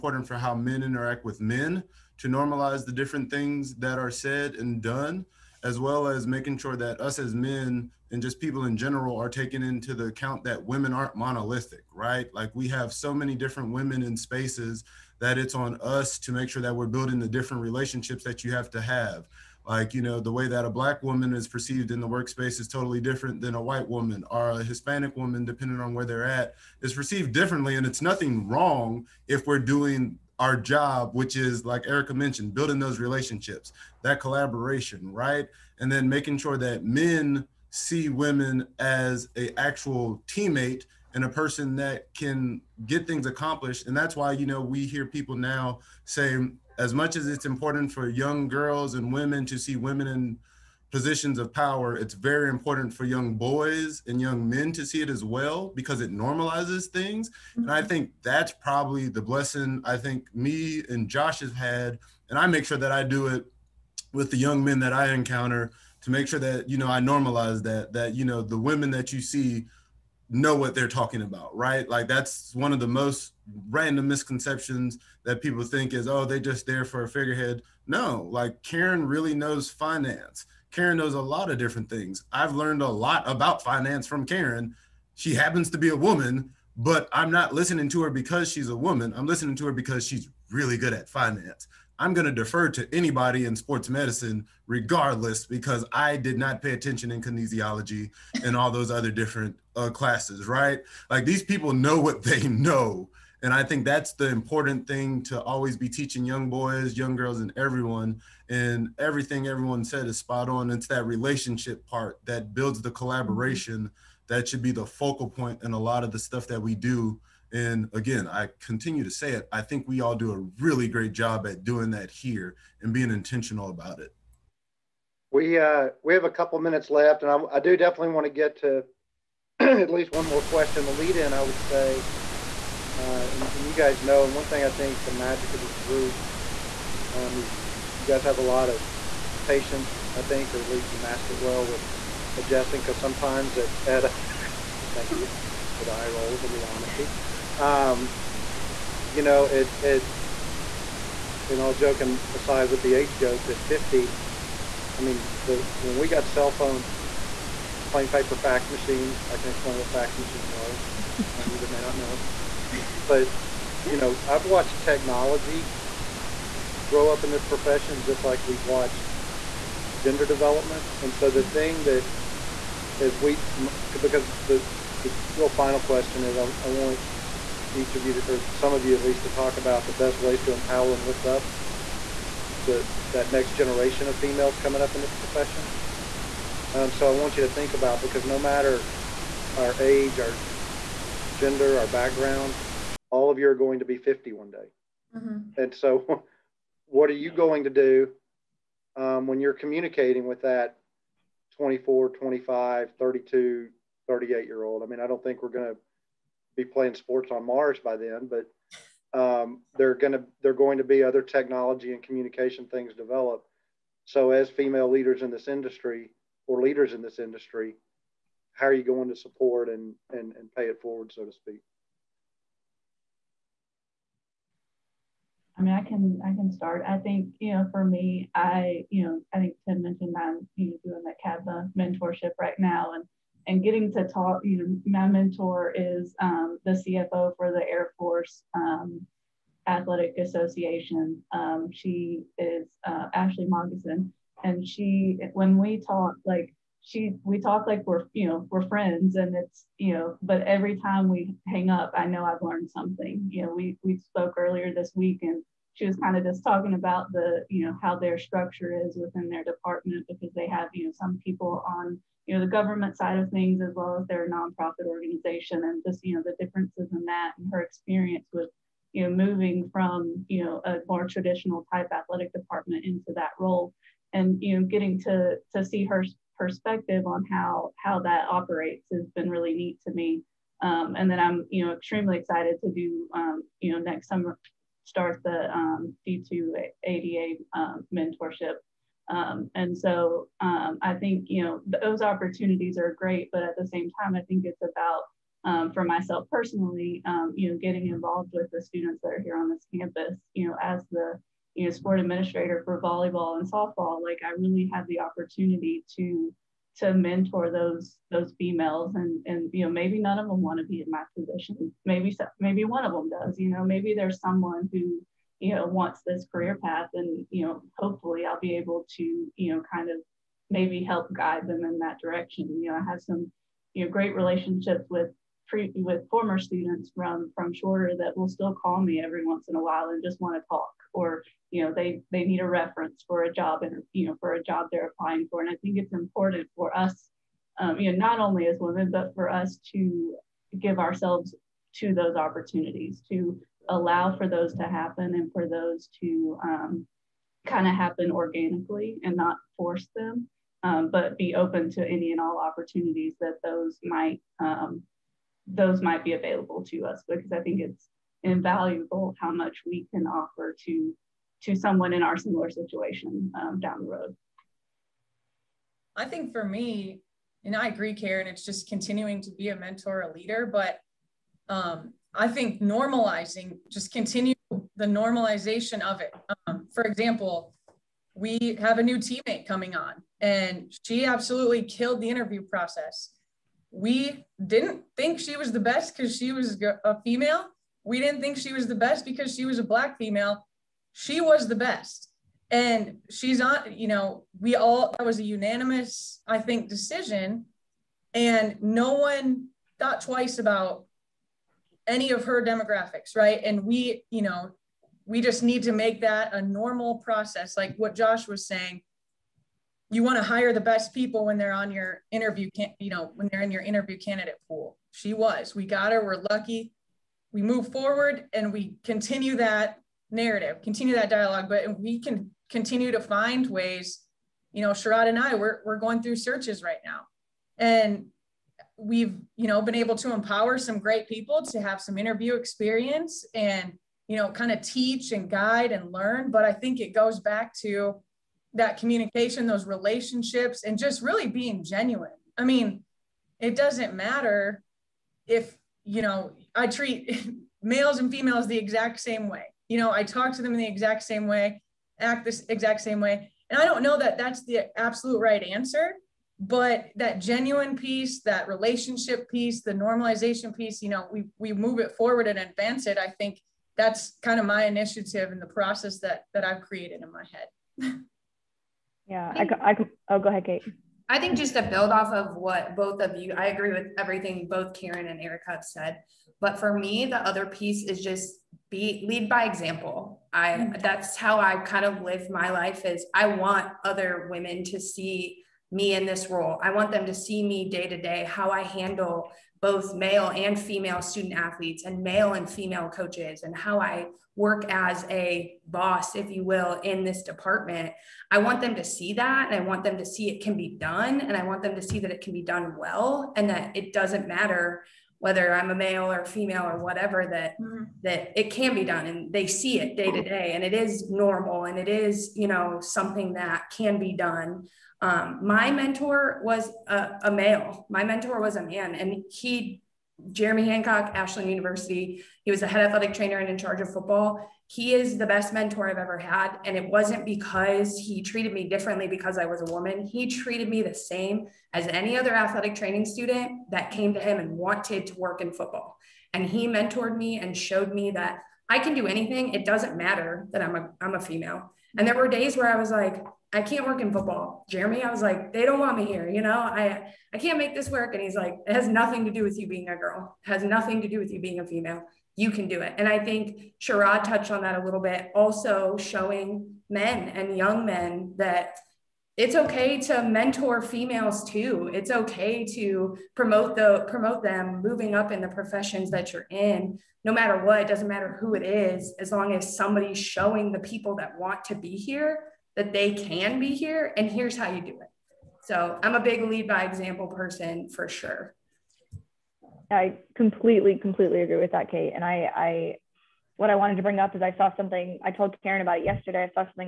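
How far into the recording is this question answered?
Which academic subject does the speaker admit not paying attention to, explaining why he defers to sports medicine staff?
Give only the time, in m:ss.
1:37.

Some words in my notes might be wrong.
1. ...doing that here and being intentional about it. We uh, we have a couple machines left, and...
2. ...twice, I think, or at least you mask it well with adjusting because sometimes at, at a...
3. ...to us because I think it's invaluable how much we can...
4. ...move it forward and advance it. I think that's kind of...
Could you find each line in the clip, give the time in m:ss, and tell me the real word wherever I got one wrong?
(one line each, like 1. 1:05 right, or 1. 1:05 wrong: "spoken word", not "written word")
1. 2:01 wrong: "minutes", not "machines"
2. 2:19 wrong: "patience", not "twice"
3. 5:56 right
4. 7:41 right.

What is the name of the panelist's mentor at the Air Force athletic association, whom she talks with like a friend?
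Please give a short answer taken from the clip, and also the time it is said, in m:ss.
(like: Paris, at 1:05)
Ashley Moggison, at 4:03.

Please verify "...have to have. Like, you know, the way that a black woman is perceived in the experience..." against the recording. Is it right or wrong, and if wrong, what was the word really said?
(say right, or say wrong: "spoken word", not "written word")
wrong: "workspace", not "experience".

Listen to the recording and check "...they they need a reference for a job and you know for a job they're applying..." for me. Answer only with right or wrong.
right.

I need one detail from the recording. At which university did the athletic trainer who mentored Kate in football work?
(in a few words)
Ashland University.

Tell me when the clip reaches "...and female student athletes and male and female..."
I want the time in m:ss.
8:10.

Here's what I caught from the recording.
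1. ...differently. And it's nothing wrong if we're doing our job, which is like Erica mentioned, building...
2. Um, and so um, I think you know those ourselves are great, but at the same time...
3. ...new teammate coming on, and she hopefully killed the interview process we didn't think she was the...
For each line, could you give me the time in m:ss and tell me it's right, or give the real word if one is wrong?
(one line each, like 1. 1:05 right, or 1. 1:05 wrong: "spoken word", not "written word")
1. 0:27 right
2. 4:49 wrong: "opportunities", not "ourselves"
3. 6:18 wrong: "absolutely", not "hopefully".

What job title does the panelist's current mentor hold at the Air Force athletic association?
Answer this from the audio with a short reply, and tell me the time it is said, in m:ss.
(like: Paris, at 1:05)
CFO, at 3:56.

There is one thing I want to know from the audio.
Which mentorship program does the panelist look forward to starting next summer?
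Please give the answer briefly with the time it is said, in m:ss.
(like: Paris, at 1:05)
D2 ADA, at 4:46.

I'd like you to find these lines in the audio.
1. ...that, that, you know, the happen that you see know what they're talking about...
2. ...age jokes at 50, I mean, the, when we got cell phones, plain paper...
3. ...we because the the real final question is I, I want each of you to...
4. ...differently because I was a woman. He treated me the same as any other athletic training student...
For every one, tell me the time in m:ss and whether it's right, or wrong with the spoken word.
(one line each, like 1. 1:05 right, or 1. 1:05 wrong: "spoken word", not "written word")
1. 1:07 wrong: "women", not "happen"
2. 2:32 right
3. 2:53 right
4. 8:48 right.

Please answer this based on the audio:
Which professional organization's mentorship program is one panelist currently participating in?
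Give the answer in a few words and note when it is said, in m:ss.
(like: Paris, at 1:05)
CABMA, at 3:51.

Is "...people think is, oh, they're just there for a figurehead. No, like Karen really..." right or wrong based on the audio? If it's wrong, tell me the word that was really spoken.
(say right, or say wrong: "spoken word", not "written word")
right.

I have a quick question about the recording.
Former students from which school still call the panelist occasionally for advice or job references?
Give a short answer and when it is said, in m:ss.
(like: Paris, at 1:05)
Shorter, at 5:27.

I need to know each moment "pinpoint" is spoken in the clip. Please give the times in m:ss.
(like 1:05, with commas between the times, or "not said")
not said.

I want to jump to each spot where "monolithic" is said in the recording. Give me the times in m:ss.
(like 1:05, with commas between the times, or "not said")
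0:11.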